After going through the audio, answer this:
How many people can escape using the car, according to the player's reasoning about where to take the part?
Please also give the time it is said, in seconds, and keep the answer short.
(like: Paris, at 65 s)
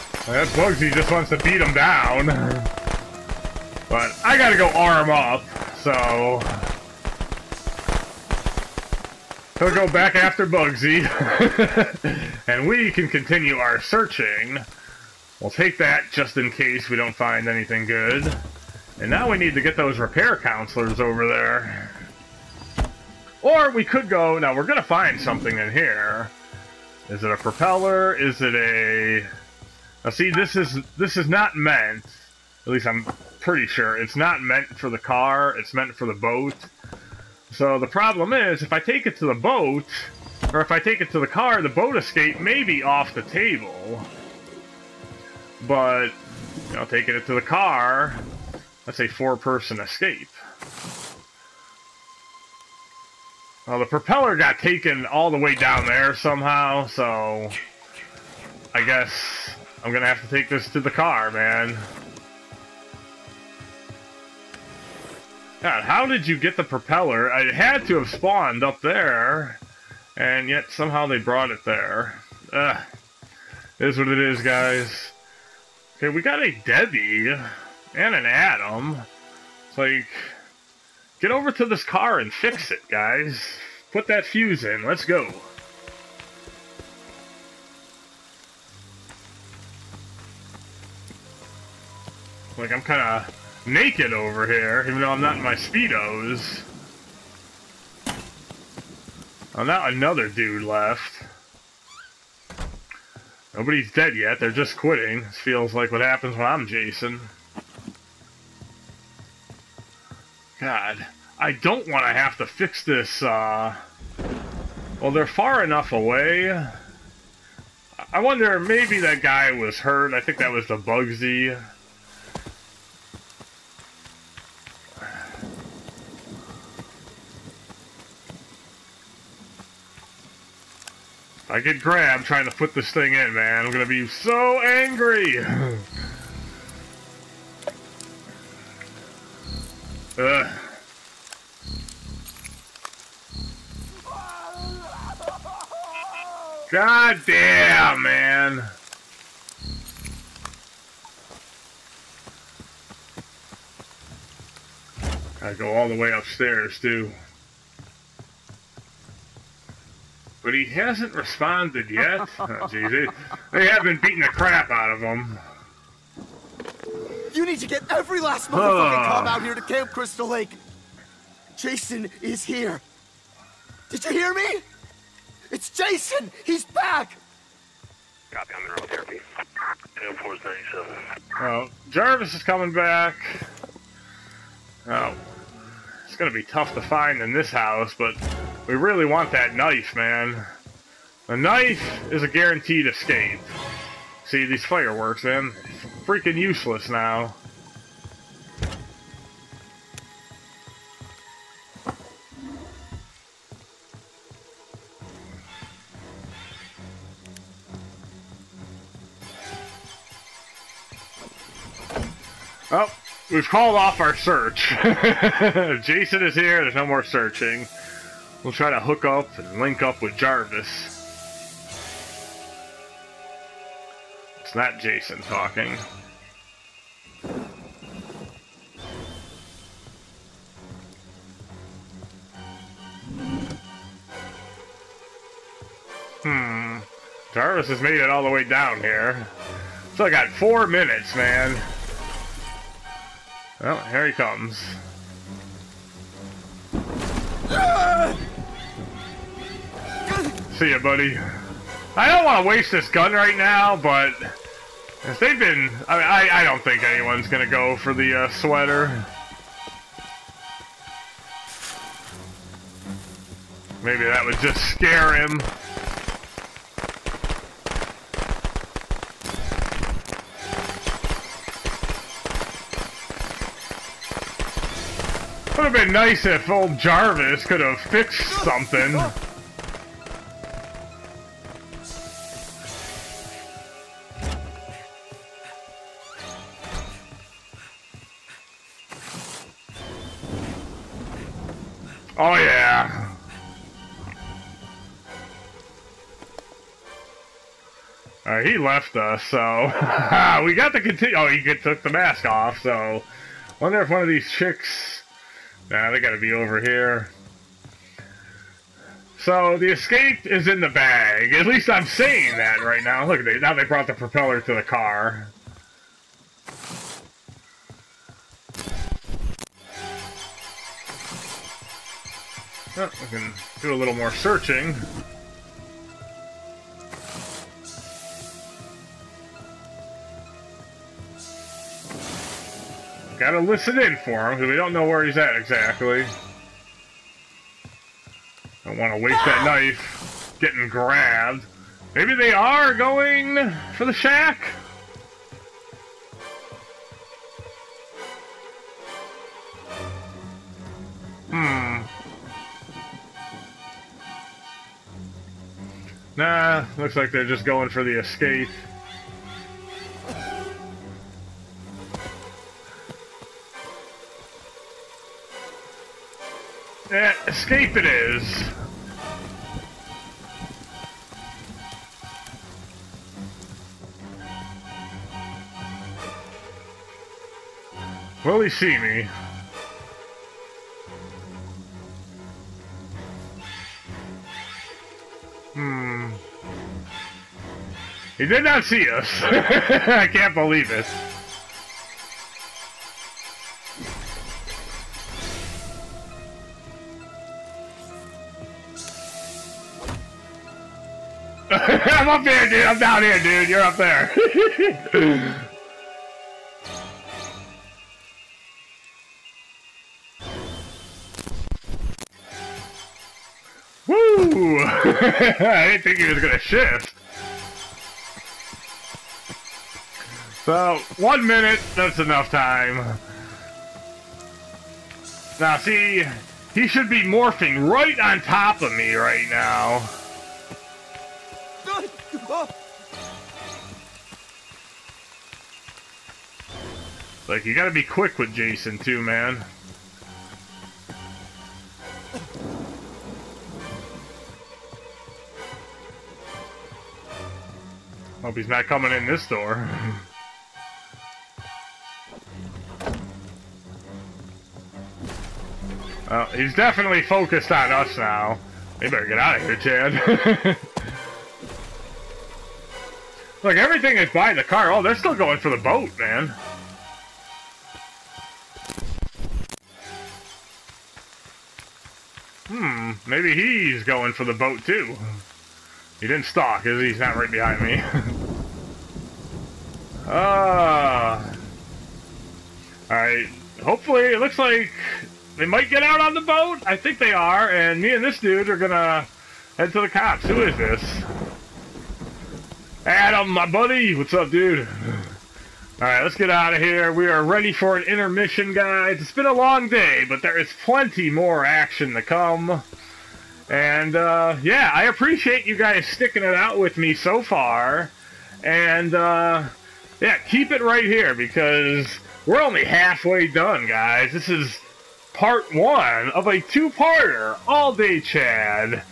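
4, at 49 s.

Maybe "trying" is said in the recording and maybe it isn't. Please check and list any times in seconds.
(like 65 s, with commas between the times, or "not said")
132 s.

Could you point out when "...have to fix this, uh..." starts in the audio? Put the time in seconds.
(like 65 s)
112 s.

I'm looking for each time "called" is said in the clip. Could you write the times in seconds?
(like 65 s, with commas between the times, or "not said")
213 s.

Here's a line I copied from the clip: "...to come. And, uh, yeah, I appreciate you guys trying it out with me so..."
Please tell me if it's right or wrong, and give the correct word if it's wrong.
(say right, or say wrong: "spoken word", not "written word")
wrong: "sticking", not "trying".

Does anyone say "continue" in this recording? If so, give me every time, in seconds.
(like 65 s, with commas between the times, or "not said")
13 s, 300 s.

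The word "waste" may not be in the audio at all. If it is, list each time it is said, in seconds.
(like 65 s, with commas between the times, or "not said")
252 s, 339 s.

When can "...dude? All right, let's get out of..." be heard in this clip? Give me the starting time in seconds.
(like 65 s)
494 s.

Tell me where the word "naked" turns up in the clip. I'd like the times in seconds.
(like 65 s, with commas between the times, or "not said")
93 s.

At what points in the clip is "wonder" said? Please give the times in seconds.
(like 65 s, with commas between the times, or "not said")
118 s, 303 s.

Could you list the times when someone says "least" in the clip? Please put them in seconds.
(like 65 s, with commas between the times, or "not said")
32 s, 311 s.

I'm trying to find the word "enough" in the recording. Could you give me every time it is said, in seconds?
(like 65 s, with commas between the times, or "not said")
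115 s, 421 s.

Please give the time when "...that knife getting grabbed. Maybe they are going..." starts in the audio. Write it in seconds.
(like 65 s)
339 s.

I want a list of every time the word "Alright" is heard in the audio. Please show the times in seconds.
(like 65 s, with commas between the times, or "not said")
482 s.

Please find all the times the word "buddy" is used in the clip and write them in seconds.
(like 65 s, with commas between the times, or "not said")
250 s, 493 s.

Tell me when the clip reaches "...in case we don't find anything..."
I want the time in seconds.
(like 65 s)
16 s.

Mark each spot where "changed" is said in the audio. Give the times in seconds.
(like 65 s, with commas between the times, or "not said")
not said.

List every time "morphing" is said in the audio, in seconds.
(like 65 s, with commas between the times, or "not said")
427 s.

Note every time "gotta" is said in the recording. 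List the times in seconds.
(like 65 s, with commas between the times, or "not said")
4 s, 305 s, 333 s, 437 s.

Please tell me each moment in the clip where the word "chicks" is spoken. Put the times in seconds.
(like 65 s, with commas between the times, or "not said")
304 s.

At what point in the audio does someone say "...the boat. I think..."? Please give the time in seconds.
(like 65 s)
486 s.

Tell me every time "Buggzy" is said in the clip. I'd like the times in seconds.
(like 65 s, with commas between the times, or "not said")
0 s, 10 s, 120 s.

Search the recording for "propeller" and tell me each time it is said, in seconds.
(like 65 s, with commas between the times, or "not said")
27 s, 53 s, 66 s, 313 s.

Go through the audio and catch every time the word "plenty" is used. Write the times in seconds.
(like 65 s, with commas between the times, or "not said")
500 s.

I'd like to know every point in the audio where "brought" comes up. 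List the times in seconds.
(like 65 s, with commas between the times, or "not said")
71 s, 313 s.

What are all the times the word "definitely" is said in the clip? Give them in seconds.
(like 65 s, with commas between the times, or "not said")
456 s.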